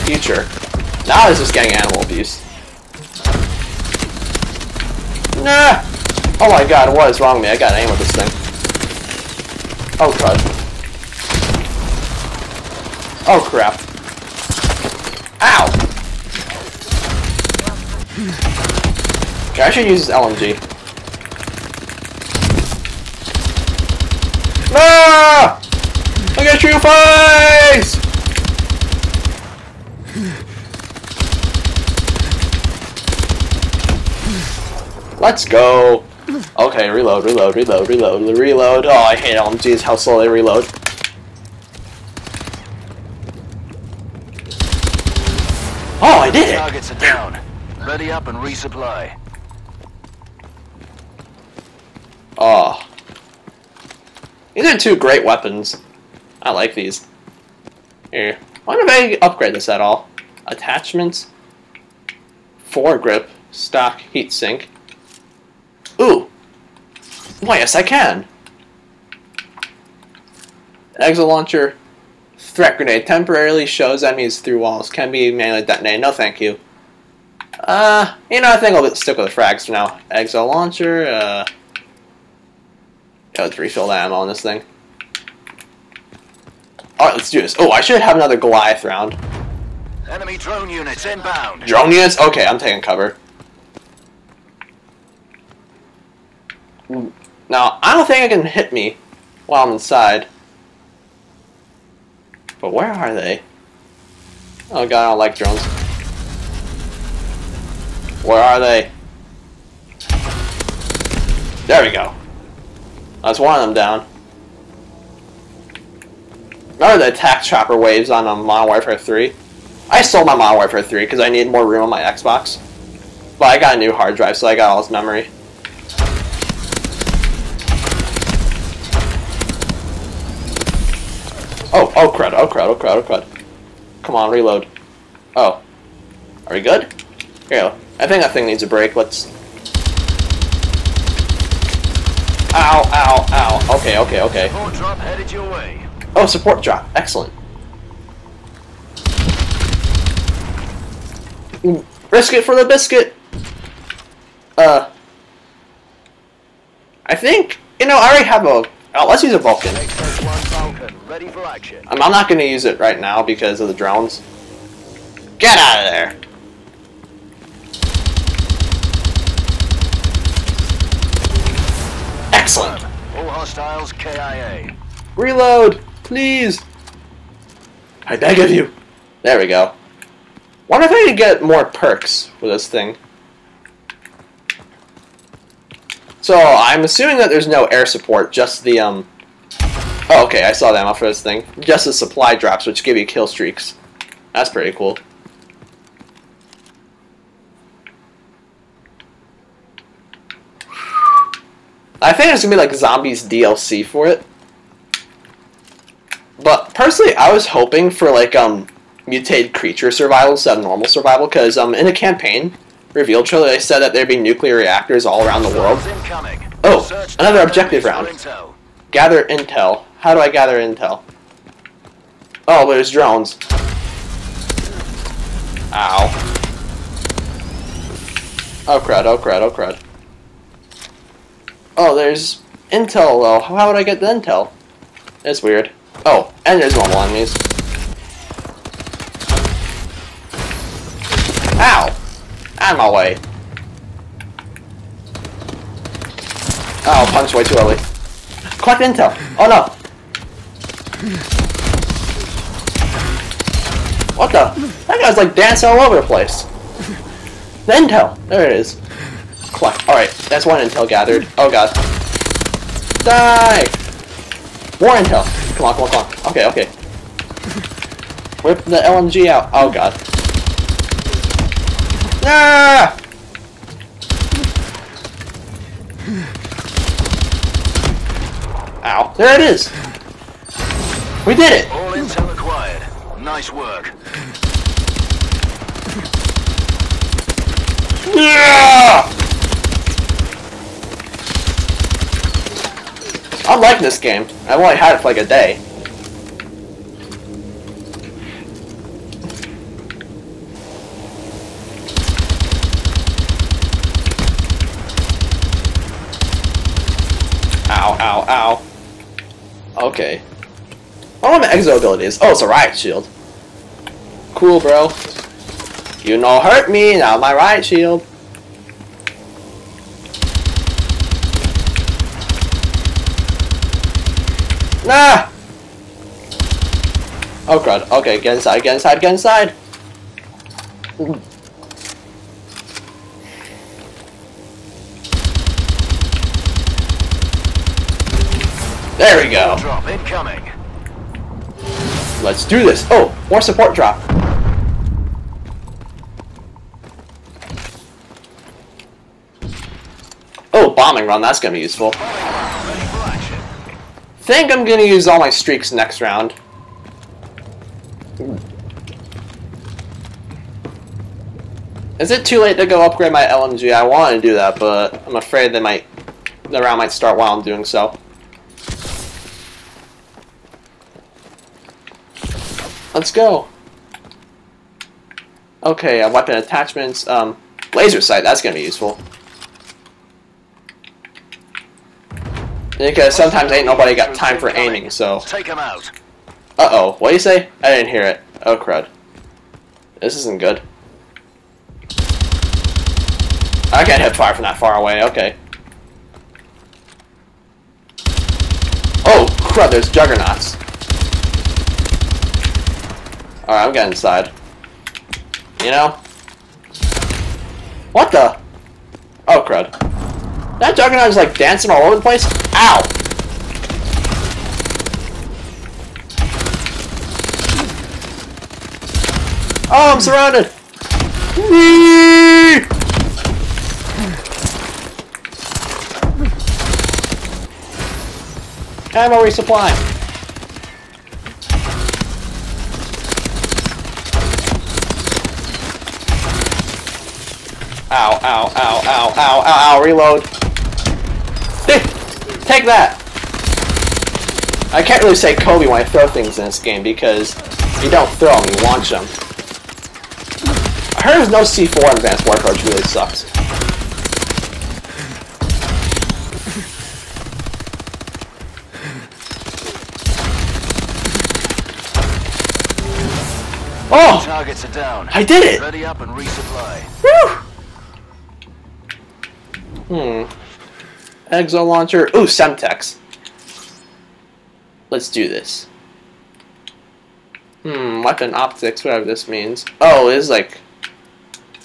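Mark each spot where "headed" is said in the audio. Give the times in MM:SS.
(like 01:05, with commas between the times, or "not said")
02:24.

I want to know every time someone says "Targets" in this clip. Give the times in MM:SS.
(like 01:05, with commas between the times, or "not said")
00:46, 07:44.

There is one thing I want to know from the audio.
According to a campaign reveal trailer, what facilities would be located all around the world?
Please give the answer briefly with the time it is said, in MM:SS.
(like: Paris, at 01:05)
Nuclear reactors, at 03:34.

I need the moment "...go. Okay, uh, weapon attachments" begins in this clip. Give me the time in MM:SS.
06:13.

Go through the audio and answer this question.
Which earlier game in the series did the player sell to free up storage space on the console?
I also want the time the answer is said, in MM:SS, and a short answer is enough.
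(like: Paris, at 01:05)
Modern Warfare 3, at 01:59.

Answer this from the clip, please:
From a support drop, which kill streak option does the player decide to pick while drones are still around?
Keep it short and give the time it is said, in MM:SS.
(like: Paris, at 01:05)
Vulcan, at 02:39.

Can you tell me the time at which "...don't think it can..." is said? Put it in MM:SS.
01:37.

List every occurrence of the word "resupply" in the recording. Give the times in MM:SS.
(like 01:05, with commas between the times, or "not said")
00:48, 07:09, 07:46.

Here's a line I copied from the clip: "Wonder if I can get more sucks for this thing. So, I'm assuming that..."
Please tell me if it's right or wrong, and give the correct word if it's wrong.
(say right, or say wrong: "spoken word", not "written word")
wrong: "perks", not "sucks".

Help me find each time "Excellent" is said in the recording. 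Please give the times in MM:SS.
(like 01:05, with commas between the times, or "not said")
02:26, 02:52.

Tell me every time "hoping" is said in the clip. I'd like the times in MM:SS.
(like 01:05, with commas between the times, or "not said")
03:27.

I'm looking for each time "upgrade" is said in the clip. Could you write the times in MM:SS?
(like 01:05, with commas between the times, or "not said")
00:59, 06:02.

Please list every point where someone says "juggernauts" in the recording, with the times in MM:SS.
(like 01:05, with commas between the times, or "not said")
06:39, 06:50.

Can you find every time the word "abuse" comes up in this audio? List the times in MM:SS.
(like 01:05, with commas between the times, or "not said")
00:02.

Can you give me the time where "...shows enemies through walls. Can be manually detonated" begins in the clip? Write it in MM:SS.
01:13.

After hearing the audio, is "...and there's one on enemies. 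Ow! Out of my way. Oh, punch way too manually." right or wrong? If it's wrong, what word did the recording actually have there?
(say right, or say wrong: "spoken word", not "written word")
wrong: "early", not "manually".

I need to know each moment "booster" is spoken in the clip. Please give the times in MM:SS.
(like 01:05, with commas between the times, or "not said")
not said.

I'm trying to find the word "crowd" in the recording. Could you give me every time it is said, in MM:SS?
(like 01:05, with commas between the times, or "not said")
not said.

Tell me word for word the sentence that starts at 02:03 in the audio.
But I got a new hard drive, so I got all this memory.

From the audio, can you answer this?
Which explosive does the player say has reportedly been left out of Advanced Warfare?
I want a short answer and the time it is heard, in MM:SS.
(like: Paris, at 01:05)
C4, at 07:31.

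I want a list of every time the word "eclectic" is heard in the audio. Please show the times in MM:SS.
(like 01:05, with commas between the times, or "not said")
not said.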